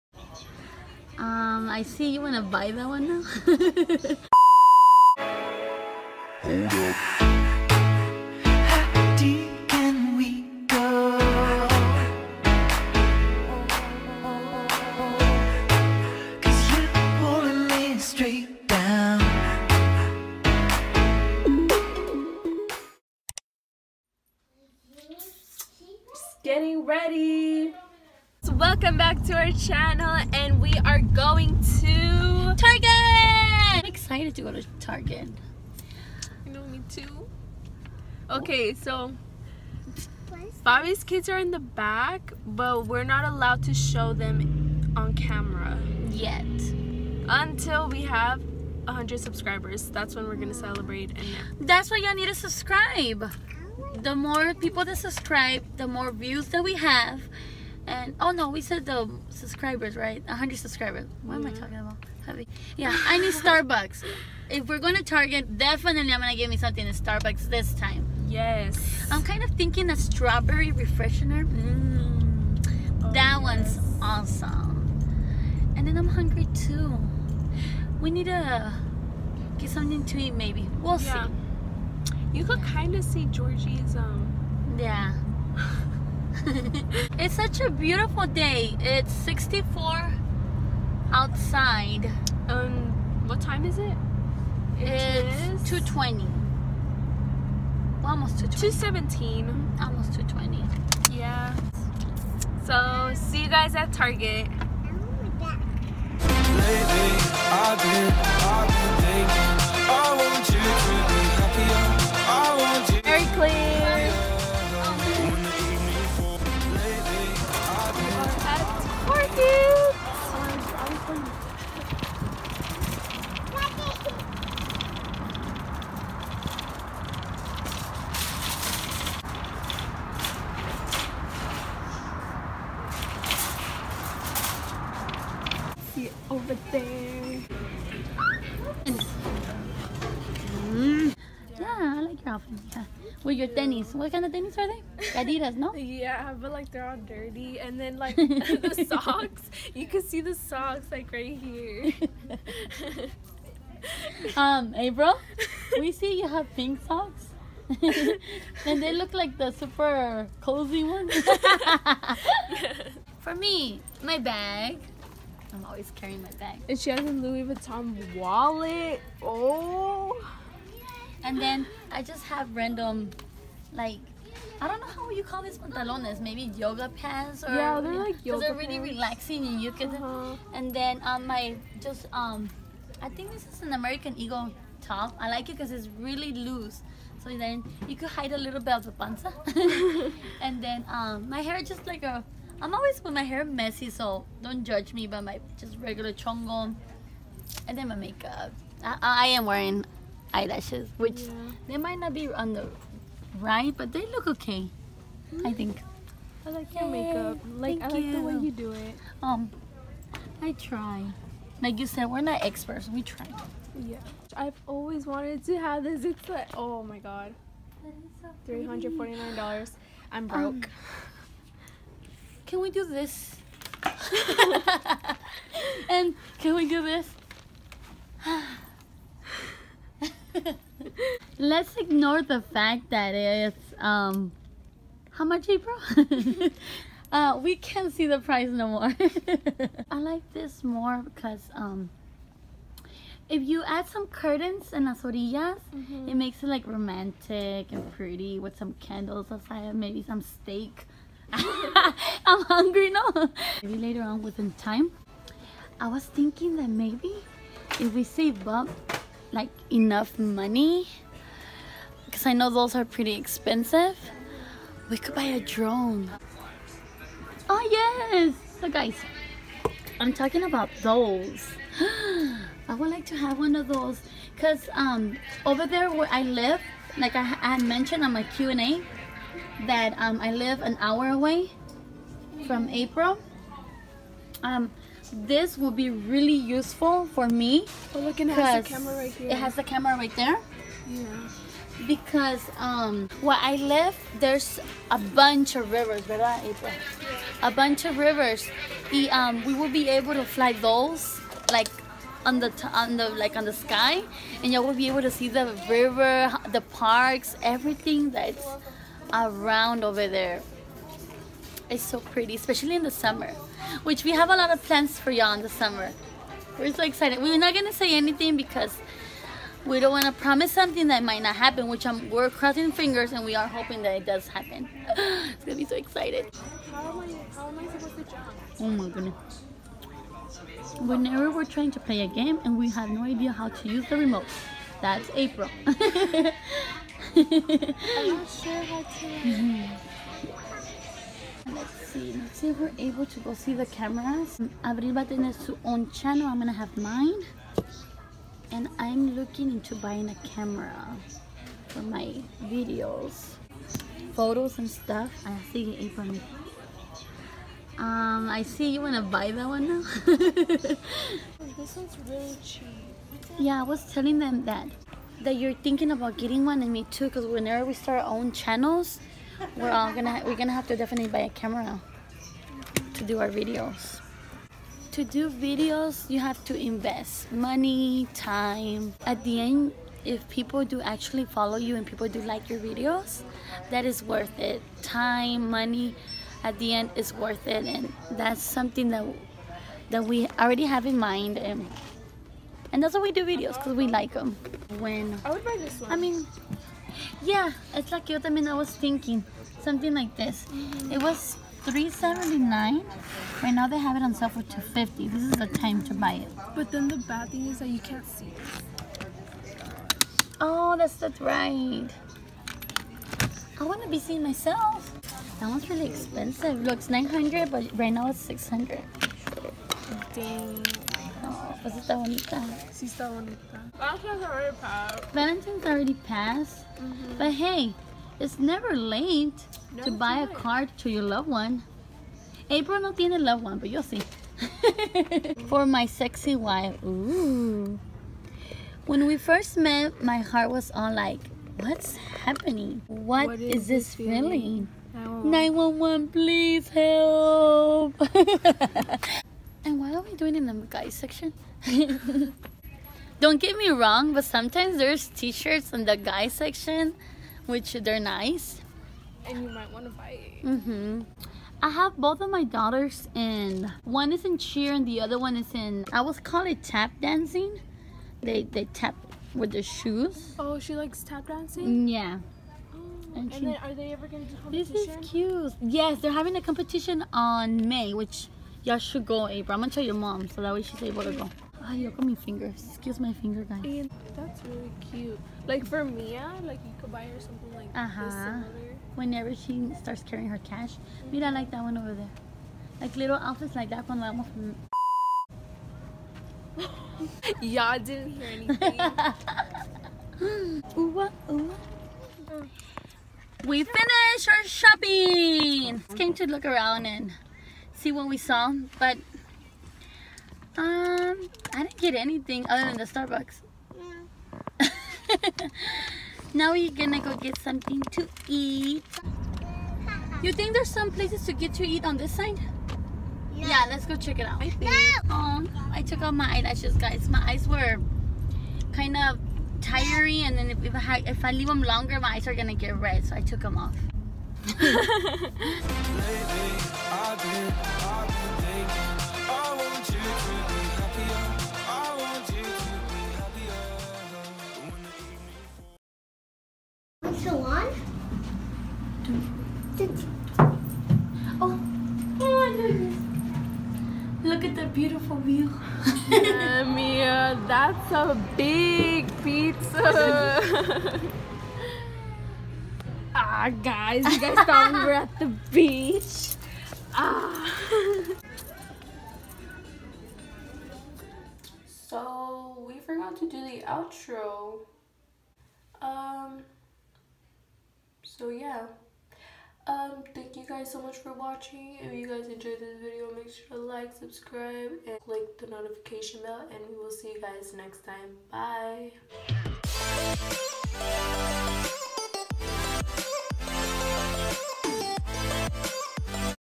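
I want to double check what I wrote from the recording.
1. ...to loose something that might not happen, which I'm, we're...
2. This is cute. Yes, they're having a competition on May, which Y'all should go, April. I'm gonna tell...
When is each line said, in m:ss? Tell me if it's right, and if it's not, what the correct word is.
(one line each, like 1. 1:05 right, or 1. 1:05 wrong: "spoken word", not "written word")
1. 5:20 wrong: "promise", not "loose"
2. 7:54 right.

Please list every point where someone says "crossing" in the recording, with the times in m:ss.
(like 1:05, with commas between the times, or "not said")
5:22.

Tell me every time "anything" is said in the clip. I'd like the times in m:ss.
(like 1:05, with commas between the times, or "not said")
5:17, 8:18, 8:31.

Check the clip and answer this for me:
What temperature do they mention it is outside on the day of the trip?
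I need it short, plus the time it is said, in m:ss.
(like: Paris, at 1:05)
64, at 1:29.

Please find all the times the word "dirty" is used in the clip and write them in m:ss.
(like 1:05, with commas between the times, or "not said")
2:26.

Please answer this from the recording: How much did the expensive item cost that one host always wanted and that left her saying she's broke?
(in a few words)
$349.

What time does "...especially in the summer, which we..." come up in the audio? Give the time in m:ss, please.
5:12.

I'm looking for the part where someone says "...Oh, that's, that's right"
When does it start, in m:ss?
6:50.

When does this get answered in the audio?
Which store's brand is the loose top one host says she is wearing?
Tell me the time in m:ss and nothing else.
3:03.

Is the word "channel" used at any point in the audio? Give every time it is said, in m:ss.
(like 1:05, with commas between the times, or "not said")
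0:29, 5:45, 6:08.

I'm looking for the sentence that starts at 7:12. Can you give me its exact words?
April no tiene loved one, but you'll see.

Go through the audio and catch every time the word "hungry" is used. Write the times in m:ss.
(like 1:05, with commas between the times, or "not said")
1:16, 4:12.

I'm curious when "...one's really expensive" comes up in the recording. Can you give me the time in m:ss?
6:55.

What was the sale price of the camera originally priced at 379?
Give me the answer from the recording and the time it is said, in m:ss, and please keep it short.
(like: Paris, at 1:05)
250, at 6:44.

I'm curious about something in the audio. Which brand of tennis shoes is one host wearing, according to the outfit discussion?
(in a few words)
Adidas.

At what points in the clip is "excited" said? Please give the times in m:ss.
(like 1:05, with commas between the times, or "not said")
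0:33, 5:16, 5:25.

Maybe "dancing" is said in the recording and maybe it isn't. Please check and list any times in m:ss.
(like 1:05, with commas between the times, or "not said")
7:47, 7:51.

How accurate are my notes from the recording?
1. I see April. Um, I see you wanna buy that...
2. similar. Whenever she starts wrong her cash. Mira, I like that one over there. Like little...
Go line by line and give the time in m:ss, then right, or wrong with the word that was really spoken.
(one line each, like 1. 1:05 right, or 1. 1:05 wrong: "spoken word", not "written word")
1. 5:55 right
2. 8:08 wrong: "carrying", not "wrong".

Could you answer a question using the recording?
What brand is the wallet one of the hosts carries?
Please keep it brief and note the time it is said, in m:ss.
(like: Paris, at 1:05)
Louis Vuitton, at 2:47.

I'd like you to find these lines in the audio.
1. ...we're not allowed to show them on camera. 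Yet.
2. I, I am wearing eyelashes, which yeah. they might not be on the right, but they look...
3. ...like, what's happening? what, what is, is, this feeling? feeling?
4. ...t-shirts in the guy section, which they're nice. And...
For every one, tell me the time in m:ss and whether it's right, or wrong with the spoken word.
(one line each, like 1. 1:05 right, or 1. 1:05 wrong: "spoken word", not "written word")
1. 0:42 right
2. 3:18 right
3. 7:21 right
4. 7:35 right.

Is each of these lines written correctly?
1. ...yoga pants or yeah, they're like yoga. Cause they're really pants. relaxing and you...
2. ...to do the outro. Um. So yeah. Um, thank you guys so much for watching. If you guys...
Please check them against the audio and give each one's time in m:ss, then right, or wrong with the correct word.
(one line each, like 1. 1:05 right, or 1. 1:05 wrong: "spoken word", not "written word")
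1. 2:56 right
2. 9:33 right.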